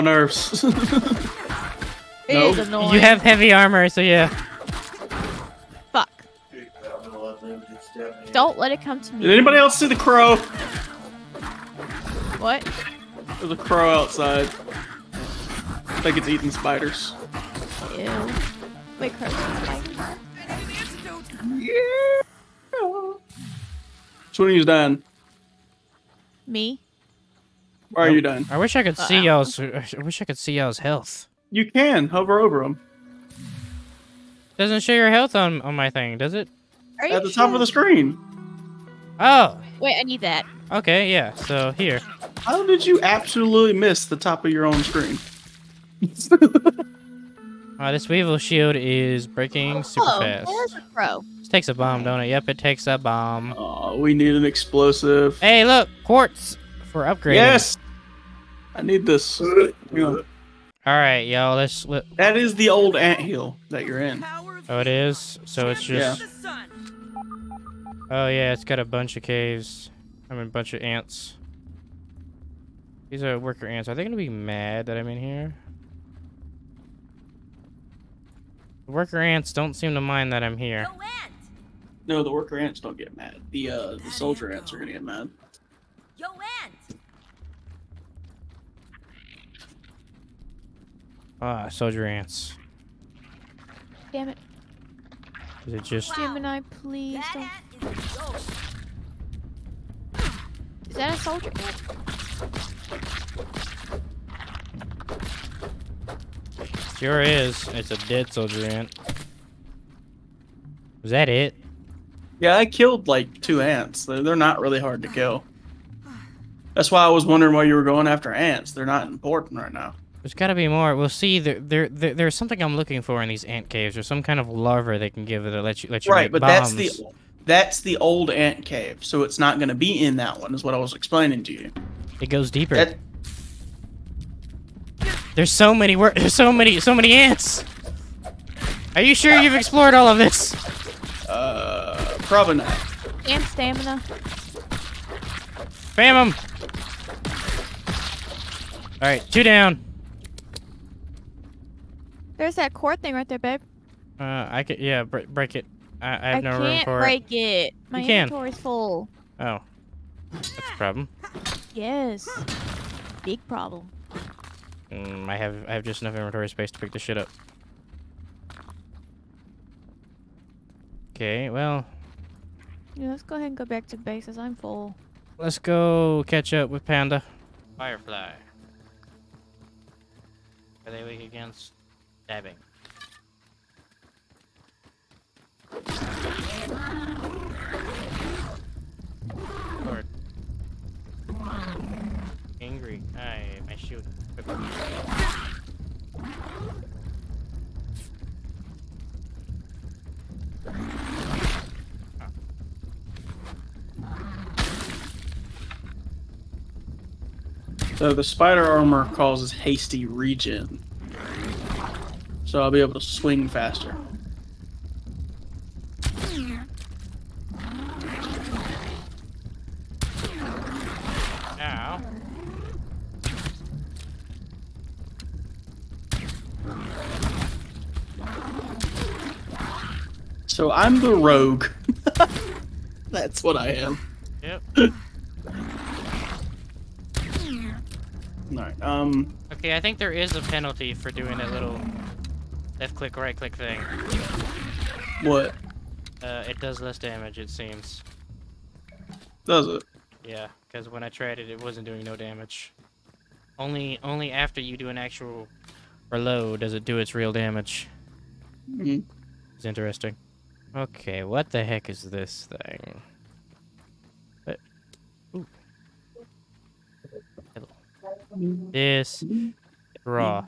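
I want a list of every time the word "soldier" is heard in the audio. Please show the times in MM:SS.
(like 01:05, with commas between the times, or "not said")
01:24, 01:31, 01:41, 01:48.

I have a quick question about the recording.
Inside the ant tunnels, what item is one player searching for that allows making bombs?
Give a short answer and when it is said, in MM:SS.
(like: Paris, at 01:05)
Larva, at 02:04.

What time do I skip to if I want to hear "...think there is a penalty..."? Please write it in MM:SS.
03:59.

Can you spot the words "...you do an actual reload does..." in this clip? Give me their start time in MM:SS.
04:14.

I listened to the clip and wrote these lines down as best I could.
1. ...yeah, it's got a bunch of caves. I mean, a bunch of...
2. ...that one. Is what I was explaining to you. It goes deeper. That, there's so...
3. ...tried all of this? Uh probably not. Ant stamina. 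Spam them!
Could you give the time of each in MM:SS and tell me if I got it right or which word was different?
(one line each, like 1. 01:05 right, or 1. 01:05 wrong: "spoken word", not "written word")
1. 01:08 right
2. 02:10 right
3. 02:19 wrong: "explored", not "tried".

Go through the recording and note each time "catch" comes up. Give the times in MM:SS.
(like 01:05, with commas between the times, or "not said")
02:56.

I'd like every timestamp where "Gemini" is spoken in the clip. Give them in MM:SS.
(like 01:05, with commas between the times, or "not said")
01:36.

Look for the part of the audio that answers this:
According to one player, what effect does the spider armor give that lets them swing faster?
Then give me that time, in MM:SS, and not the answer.
03:29.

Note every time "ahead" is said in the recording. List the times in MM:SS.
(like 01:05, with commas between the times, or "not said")
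02:53.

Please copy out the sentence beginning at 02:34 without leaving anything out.
Uh, I could, yeah, break, break it.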